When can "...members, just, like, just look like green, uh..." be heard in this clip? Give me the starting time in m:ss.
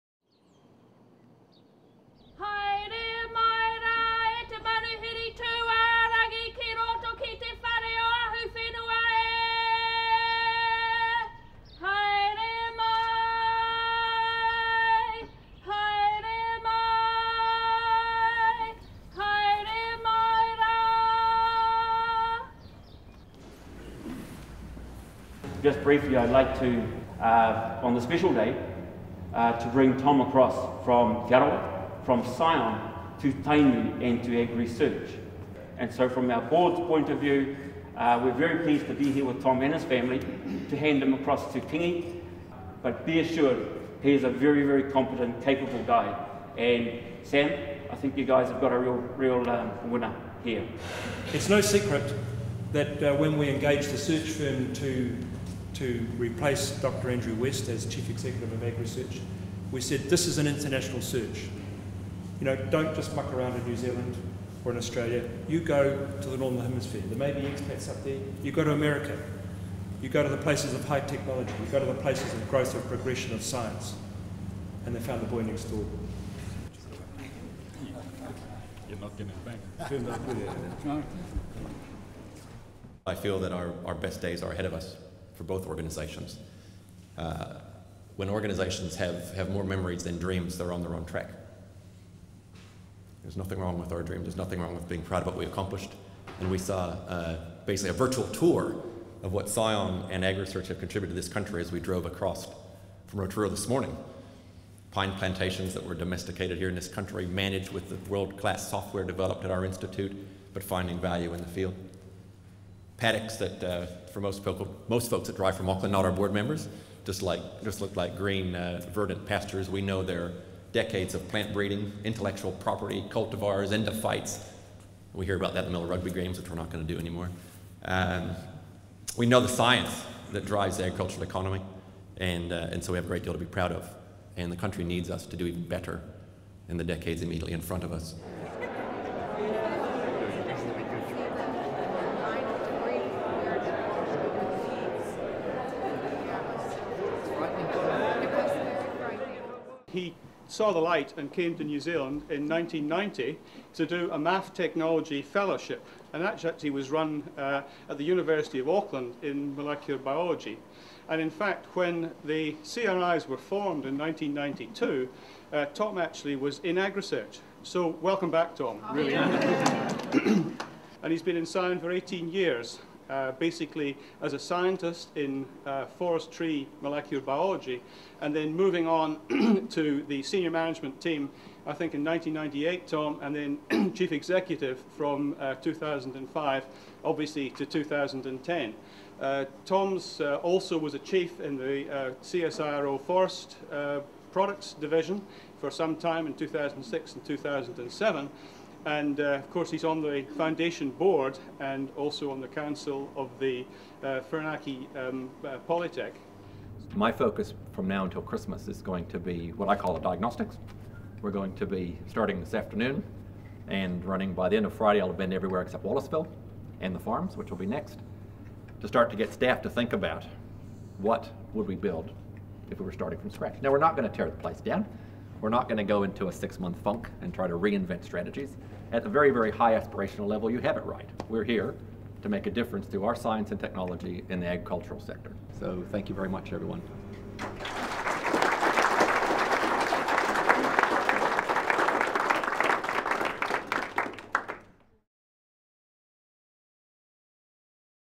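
1:56.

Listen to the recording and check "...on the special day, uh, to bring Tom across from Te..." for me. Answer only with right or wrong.
right.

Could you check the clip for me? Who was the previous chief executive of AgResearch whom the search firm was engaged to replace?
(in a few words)
Dr. Andrew West.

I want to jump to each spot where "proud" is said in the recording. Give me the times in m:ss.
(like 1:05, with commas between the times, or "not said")
1:35, 2:13.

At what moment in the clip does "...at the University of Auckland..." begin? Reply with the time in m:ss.
2:37.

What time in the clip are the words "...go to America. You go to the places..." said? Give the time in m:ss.
1:08.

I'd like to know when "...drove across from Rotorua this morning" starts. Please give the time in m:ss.
1:41.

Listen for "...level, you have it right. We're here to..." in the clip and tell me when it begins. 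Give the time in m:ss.
3:50.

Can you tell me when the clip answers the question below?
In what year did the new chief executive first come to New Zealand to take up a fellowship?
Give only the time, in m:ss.
2:32.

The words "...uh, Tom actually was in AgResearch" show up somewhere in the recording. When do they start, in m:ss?
2:45.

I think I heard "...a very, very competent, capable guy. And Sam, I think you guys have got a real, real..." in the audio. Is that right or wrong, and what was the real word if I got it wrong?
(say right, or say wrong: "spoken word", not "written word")
right.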